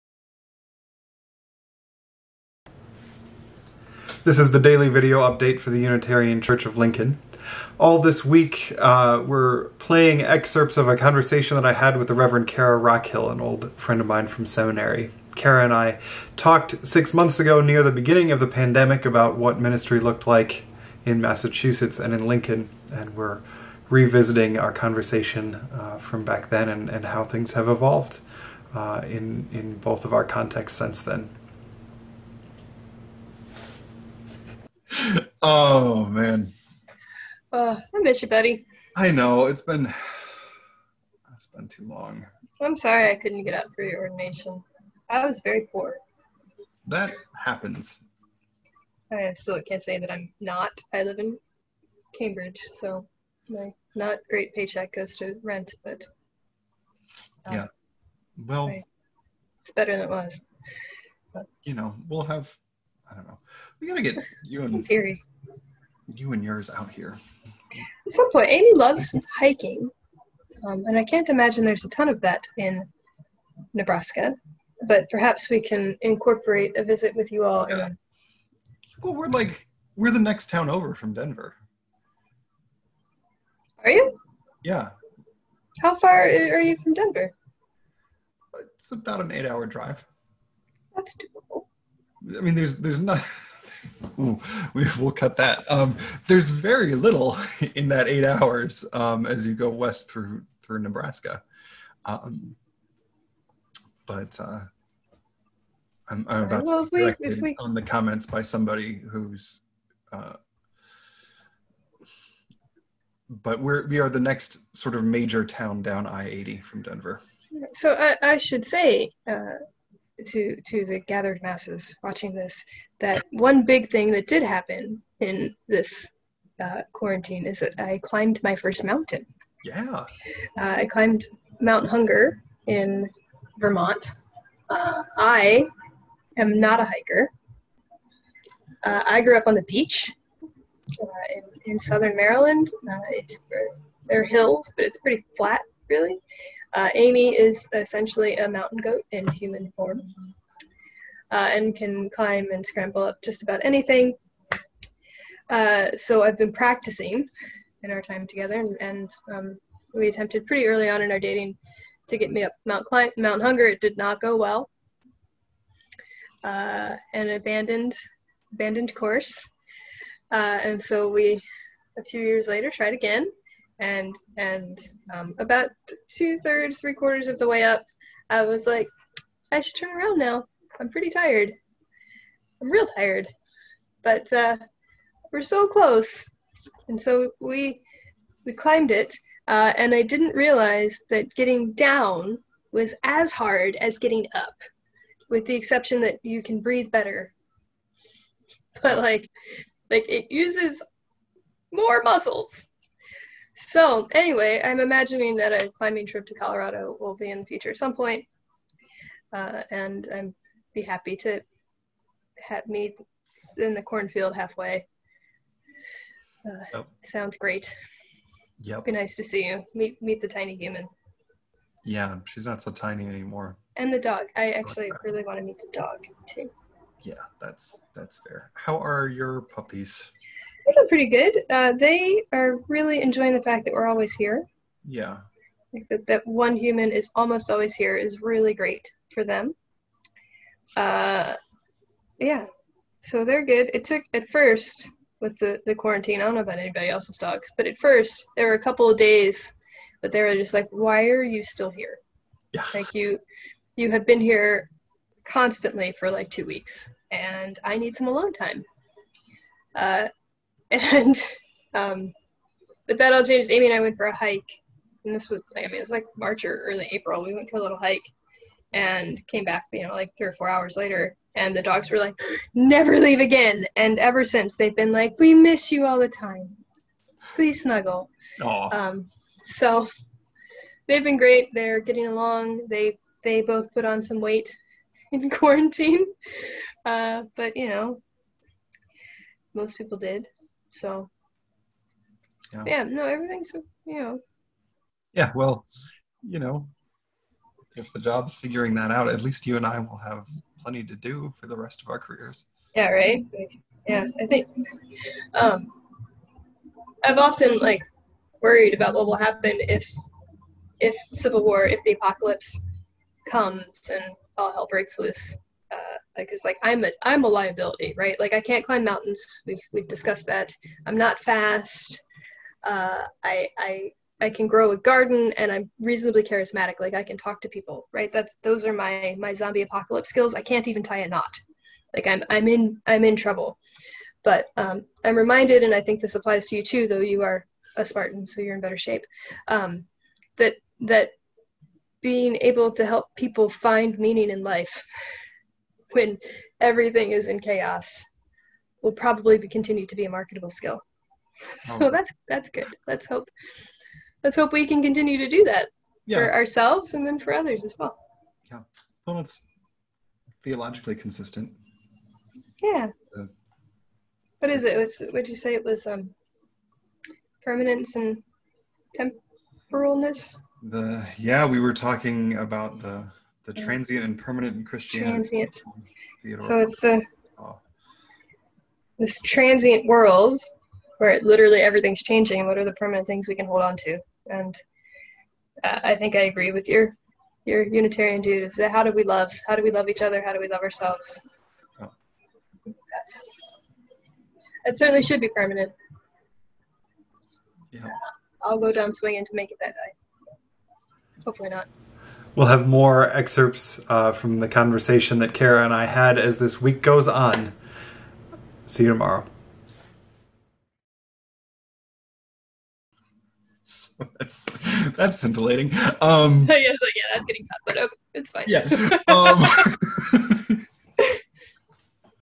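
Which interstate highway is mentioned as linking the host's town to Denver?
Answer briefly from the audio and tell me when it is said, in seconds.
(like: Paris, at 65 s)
I-80, at 116 s.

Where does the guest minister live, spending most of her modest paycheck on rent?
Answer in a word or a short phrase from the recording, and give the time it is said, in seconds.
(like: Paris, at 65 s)
Cambridge, at 52 s.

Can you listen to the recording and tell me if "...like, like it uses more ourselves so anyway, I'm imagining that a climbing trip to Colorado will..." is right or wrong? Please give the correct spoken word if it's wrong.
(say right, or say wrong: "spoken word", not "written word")
wrong: "muscles", not "ourselves".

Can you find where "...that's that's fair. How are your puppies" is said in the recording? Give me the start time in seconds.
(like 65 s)
227 s.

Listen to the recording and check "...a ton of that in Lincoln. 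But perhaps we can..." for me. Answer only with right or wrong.
wrong.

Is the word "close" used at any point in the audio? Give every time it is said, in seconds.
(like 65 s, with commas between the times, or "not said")
185 s.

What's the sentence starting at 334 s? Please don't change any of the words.
But um, I'm reminded, and I think this applies to you too, though you are a Spartan, so you're in better shape.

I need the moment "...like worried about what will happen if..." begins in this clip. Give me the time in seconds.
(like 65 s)
307 s.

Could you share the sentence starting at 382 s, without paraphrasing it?
And what are the permanent things we can hold on to?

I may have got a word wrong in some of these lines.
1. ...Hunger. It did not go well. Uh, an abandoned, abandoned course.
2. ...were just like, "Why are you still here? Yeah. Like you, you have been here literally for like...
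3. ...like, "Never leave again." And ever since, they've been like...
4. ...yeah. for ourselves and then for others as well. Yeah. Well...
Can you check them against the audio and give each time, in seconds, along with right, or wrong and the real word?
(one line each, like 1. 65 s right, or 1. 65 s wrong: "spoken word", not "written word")
1. 163 s right
2. 250 s wrong: "constantly", not "literally"
3. 271 s right
4. 356 s right.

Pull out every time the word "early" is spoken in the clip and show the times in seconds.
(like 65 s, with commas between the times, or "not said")
160 s, 266 s.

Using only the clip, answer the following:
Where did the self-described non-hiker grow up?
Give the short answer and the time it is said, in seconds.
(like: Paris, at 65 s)
Southern Maryland, at 141 s.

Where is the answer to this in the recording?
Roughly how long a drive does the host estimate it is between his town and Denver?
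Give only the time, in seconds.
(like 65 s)
89 s.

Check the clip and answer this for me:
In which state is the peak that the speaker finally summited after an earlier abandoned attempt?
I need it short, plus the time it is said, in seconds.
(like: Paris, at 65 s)
Vermont, at 133 s.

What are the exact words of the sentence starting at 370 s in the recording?
The yeah, we were talking about the the transient and permanent in Christianity.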